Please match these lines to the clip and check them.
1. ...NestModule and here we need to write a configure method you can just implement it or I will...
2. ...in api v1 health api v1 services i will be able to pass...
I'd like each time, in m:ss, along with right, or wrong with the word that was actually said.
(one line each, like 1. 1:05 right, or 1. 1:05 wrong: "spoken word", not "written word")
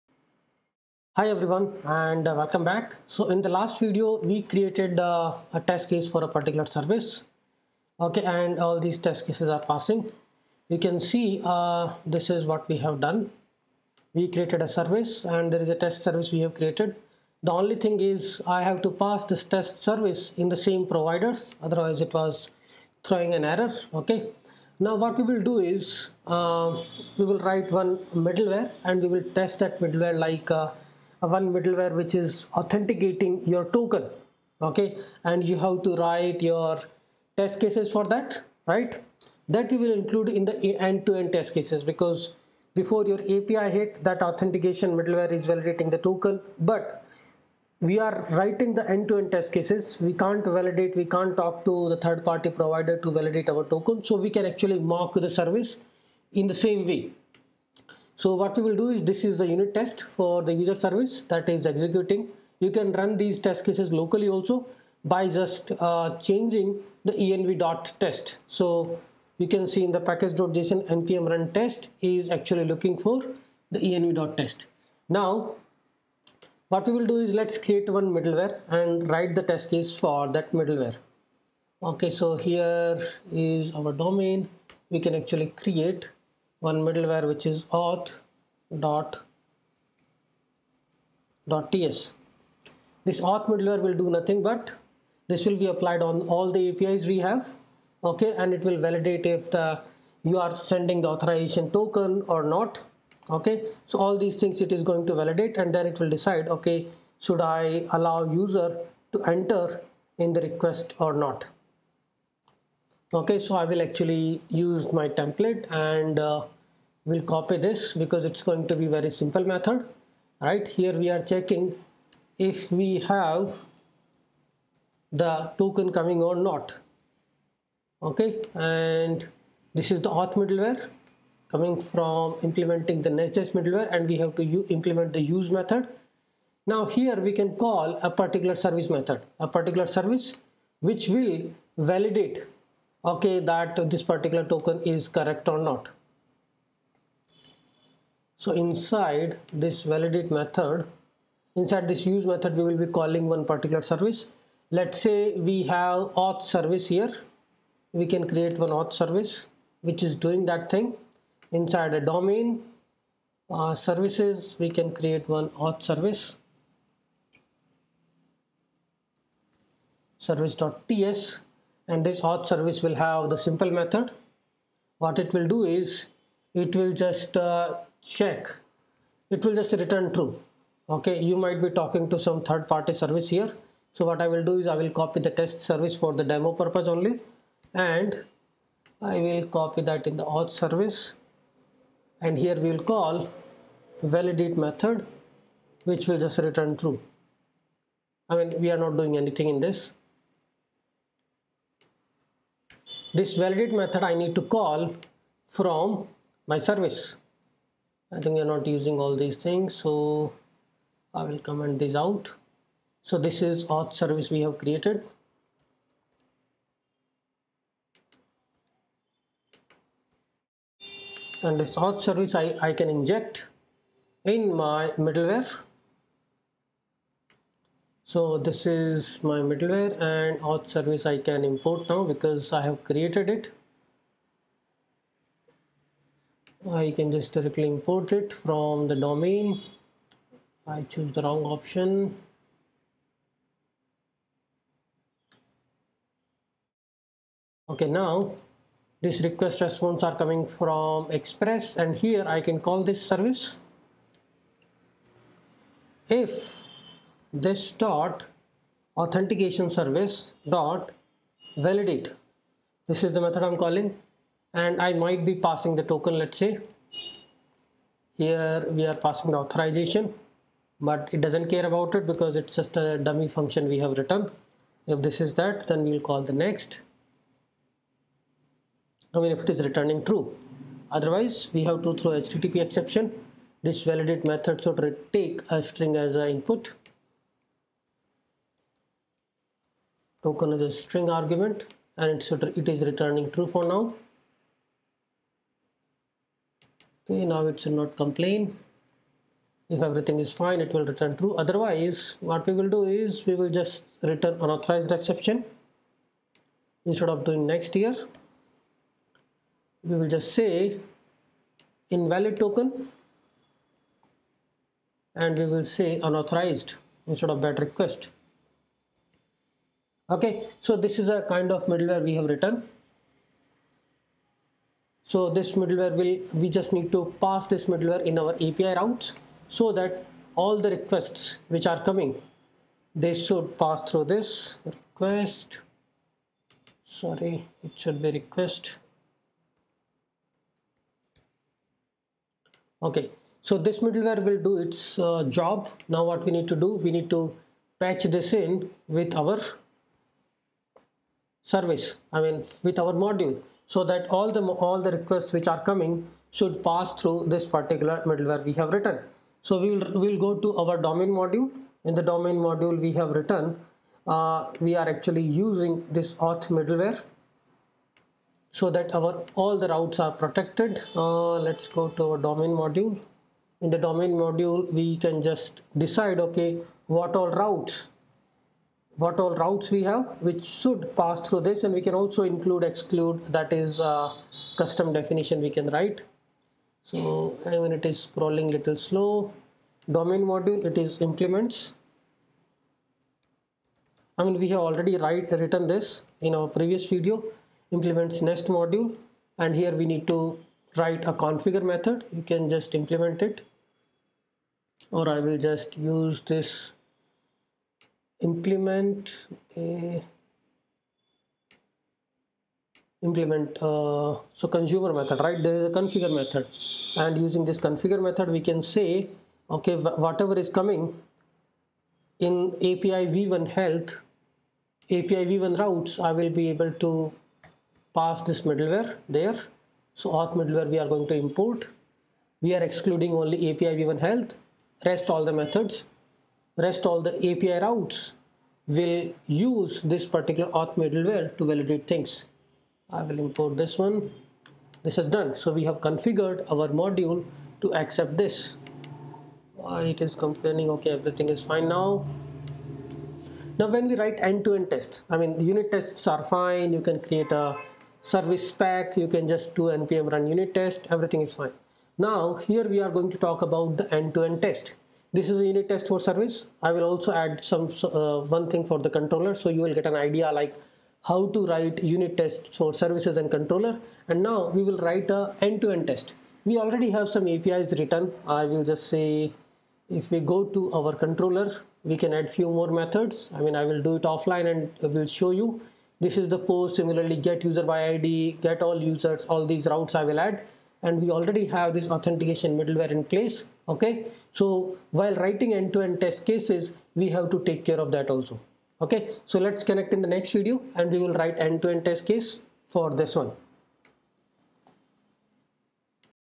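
1. 6:38 right
2. 7:02 wrong: "routes", not "services".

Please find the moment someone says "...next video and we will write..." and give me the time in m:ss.
8:20.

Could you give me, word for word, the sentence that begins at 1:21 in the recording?
Okay, so here is our domain.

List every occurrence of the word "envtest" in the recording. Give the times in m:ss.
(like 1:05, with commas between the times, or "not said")
1:07, 1:13.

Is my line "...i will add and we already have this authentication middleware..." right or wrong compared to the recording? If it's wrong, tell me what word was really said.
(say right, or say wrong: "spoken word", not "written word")
right.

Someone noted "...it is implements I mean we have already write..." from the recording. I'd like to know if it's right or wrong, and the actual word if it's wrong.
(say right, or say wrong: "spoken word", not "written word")
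right.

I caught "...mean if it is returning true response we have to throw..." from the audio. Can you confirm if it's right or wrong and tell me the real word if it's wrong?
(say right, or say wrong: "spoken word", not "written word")
wrong: "otherwise", not "response".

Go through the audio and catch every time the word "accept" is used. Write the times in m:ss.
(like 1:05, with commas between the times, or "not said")
7:27.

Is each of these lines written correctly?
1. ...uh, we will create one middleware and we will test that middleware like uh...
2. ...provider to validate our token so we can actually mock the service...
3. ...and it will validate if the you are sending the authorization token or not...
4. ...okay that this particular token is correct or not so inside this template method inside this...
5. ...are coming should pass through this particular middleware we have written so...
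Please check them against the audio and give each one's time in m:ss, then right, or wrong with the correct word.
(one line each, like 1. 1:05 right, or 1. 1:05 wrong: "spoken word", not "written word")
1. 0:26 wrong: "write", not "create"
2. 0:52 right
3. 1:38 right
4. 2:23 wrong: "validate", not "template"
5. 5:55 right.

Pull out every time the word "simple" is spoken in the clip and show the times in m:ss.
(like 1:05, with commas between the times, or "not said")
1:59, 2:53.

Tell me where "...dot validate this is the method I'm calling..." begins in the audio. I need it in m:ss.
4:20.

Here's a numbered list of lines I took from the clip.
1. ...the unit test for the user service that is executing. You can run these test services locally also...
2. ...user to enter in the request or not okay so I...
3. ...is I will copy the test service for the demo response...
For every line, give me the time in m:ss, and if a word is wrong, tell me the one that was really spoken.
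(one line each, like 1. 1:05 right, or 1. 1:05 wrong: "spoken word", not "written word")
1. 0:59 wrong: "cases", not "services"
2. 1:48 right
3. 3:04 wrong: "purpose", not "response".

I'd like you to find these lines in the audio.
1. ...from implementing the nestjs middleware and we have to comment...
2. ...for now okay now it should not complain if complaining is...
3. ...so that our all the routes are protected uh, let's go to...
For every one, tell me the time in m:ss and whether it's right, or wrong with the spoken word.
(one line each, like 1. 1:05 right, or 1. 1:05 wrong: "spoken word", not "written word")
1. 2:11 wrong: "implement", not "comment"
2. 4:53 wrong: "everything", not "complaining"
3. 6:08 right.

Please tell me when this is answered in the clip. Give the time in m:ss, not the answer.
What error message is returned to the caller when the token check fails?
5:11.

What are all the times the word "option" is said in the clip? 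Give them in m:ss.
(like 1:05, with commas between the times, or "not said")
4:01.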